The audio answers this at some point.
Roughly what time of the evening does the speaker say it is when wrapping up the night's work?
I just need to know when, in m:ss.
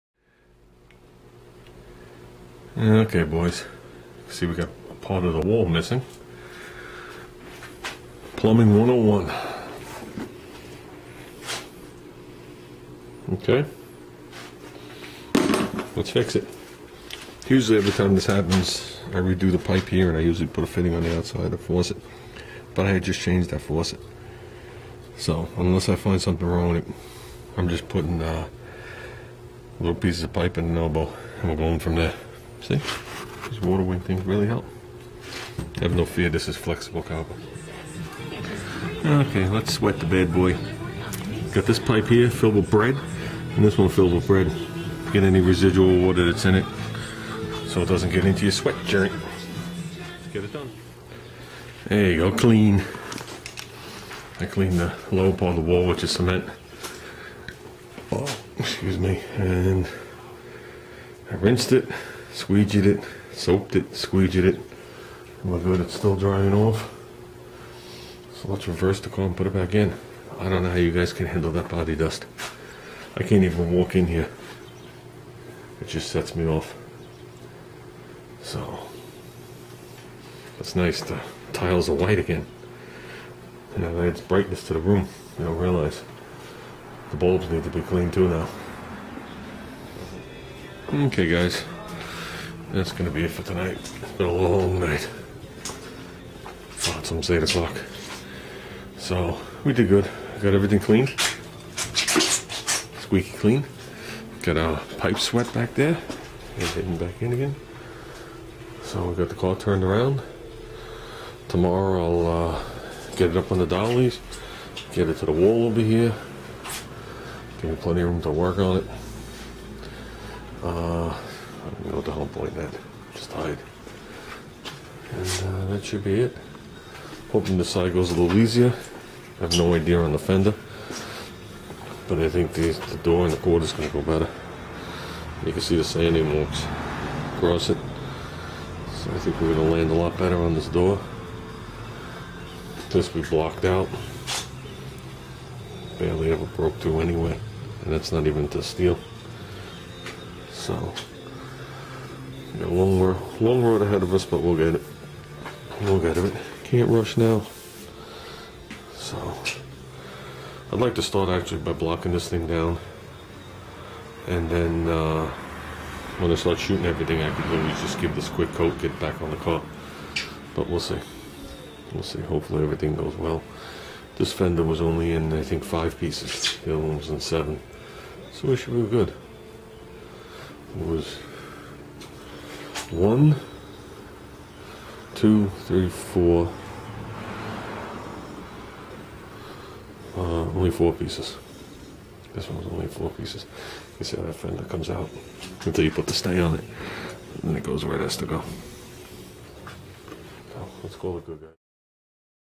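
1:37.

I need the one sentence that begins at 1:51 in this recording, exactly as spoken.
Tomorrow I'll uh, get it up on the dollies.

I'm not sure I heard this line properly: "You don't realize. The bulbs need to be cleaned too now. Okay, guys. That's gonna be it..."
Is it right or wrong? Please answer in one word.
right.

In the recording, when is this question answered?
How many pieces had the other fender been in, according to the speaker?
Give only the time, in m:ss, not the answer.
2:57.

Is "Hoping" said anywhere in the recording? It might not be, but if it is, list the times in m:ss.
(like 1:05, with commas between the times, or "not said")
2:07.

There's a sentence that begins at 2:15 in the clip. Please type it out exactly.
You can see the sanding marks across it.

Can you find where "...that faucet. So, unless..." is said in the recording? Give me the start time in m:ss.
0:23.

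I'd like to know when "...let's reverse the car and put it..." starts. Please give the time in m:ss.
1:08.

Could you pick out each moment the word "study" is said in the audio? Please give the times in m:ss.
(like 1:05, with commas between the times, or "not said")
not said.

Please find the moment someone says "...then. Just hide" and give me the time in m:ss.
2:02.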